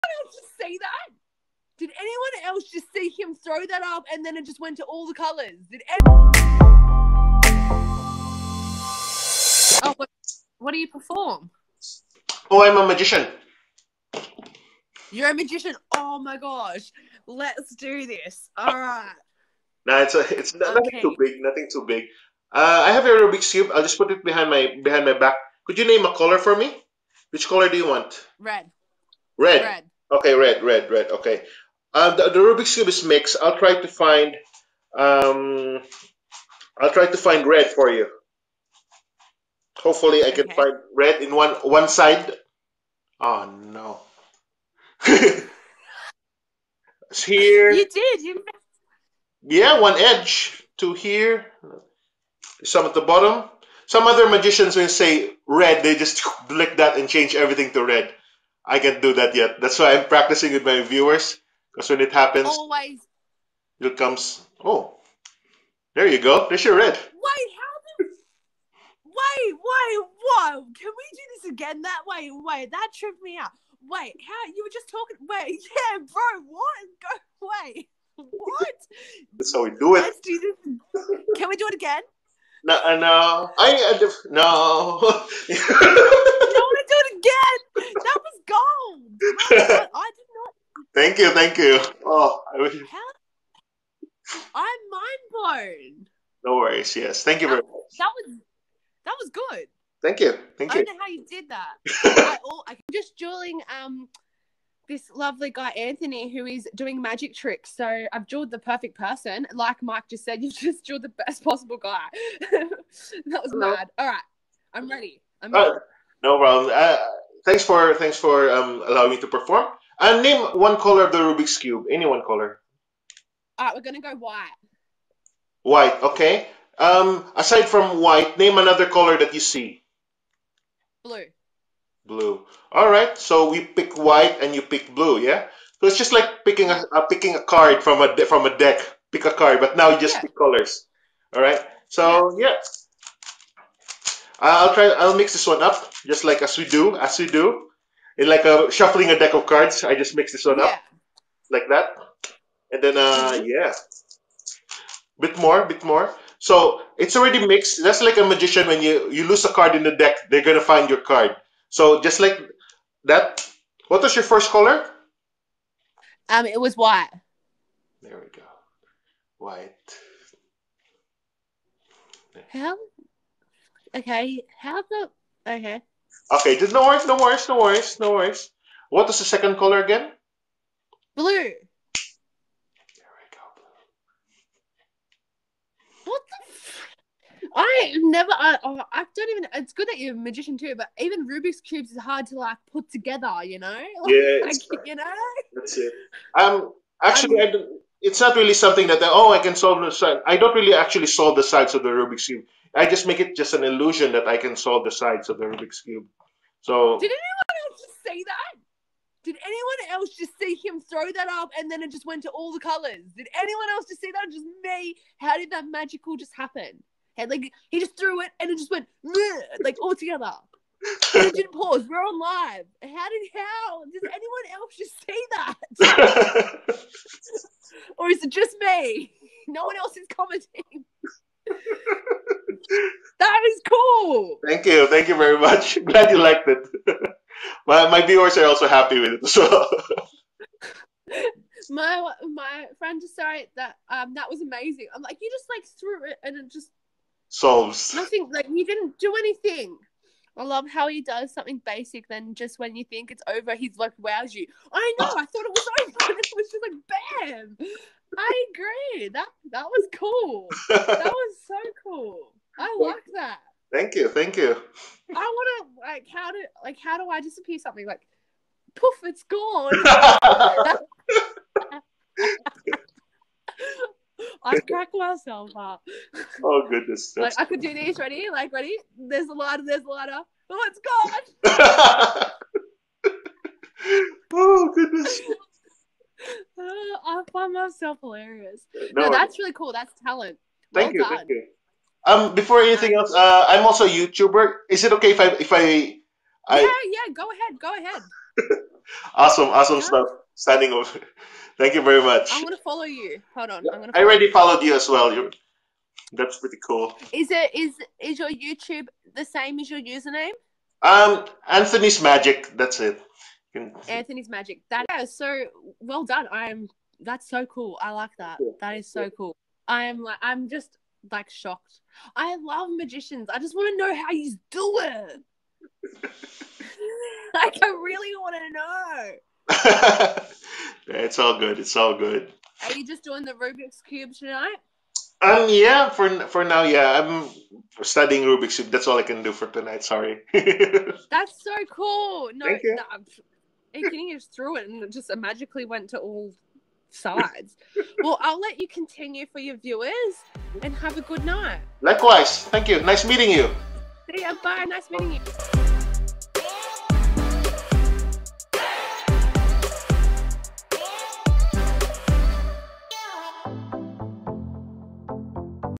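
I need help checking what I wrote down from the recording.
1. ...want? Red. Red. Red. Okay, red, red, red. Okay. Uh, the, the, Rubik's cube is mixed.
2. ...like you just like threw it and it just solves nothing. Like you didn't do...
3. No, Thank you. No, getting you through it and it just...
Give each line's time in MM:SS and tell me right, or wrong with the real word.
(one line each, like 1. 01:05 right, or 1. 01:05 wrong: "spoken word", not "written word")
1. 00:27 right
2. 04:05 right
3. 05:42 right.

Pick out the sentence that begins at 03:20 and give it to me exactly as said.
I don't really actually solve the sides of the Rubik's cube.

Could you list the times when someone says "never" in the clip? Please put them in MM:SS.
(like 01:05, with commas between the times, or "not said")
03:08.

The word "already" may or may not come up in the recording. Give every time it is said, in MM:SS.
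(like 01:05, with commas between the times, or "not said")
02:37, 05:04.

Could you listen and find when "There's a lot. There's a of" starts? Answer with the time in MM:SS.
04:38.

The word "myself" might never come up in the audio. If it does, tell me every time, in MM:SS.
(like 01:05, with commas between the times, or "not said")
04:34, 04:47.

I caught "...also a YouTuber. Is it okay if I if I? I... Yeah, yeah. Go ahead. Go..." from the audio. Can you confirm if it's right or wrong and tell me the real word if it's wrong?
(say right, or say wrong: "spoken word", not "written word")
right.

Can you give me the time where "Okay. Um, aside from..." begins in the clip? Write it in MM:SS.
02:06.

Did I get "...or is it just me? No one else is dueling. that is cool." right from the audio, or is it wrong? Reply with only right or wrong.
wrong.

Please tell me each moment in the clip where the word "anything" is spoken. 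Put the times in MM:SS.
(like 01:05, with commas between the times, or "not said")
04:09, 04:52.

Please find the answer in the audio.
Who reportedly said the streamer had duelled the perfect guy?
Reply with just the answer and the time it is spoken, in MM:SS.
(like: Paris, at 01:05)
Mike, at 01:49.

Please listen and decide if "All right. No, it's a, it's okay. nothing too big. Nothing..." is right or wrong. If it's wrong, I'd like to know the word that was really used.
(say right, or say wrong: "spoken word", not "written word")
right.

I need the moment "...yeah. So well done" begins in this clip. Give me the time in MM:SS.
05:14.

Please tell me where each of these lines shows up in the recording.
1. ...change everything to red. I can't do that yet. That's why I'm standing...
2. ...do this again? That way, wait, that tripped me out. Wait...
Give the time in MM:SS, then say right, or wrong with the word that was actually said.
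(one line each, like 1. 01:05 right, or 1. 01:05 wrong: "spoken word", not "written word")
1. 00:57 wrong: "practicing", not "standing"
2. 01:11 right.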